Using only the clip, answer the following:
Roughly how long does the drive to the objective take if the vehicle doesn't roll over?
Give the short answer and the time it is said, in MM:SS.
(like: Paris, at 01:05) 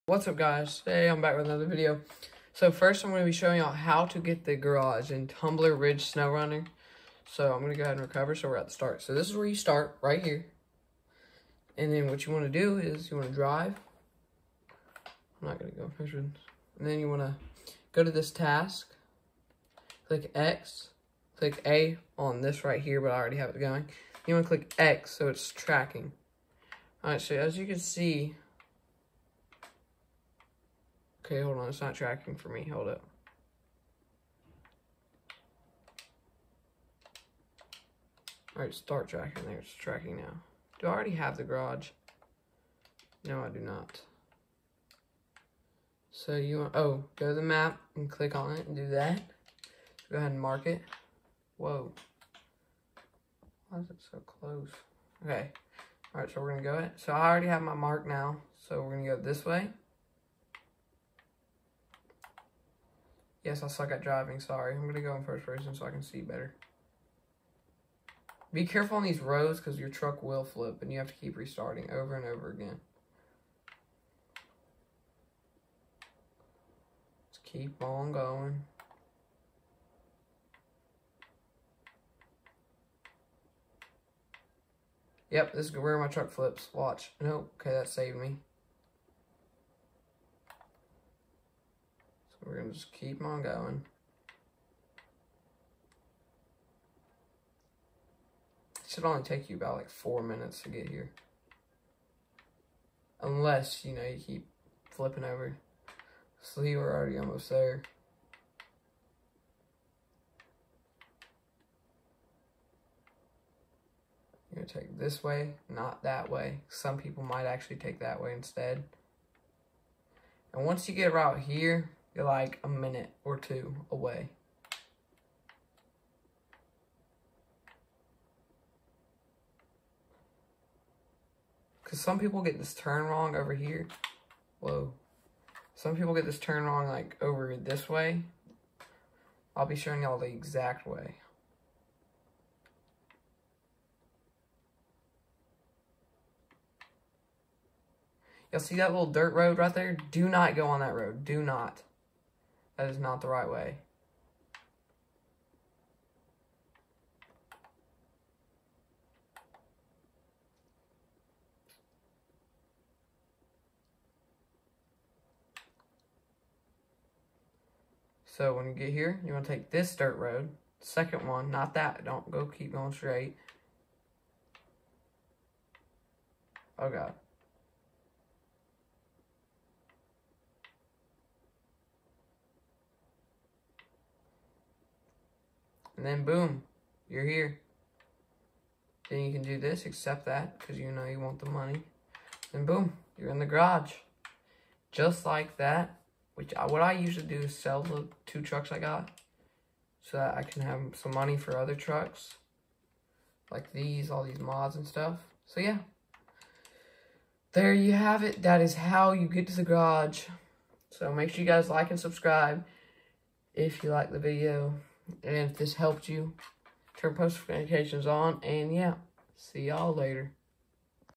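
4 minutes, at 01:39.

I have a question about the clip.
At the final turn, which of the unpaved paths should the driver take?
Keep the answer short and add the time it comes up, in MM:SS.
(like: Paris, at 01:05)
second one, at 02:50.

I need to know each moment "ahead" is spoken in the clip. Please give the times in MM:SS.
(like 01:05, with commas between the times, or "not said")
00:07, 00:50.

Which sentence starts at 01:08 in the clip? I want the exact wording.
Be careful on these roads because your truck will flip and you have to keep restarting over and over again.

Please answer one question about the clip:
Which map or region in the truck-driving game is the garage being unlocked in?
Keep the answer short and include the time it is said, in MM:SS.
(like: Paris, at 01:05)
Tumbler Ridge, at 00:05.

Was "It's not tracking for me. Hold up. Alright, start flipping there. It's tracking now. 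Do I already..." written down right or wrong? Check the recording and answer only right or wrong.
wrong.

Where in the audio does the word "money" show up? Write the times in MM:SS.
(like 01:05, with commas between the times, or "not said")
03:11, 03:21.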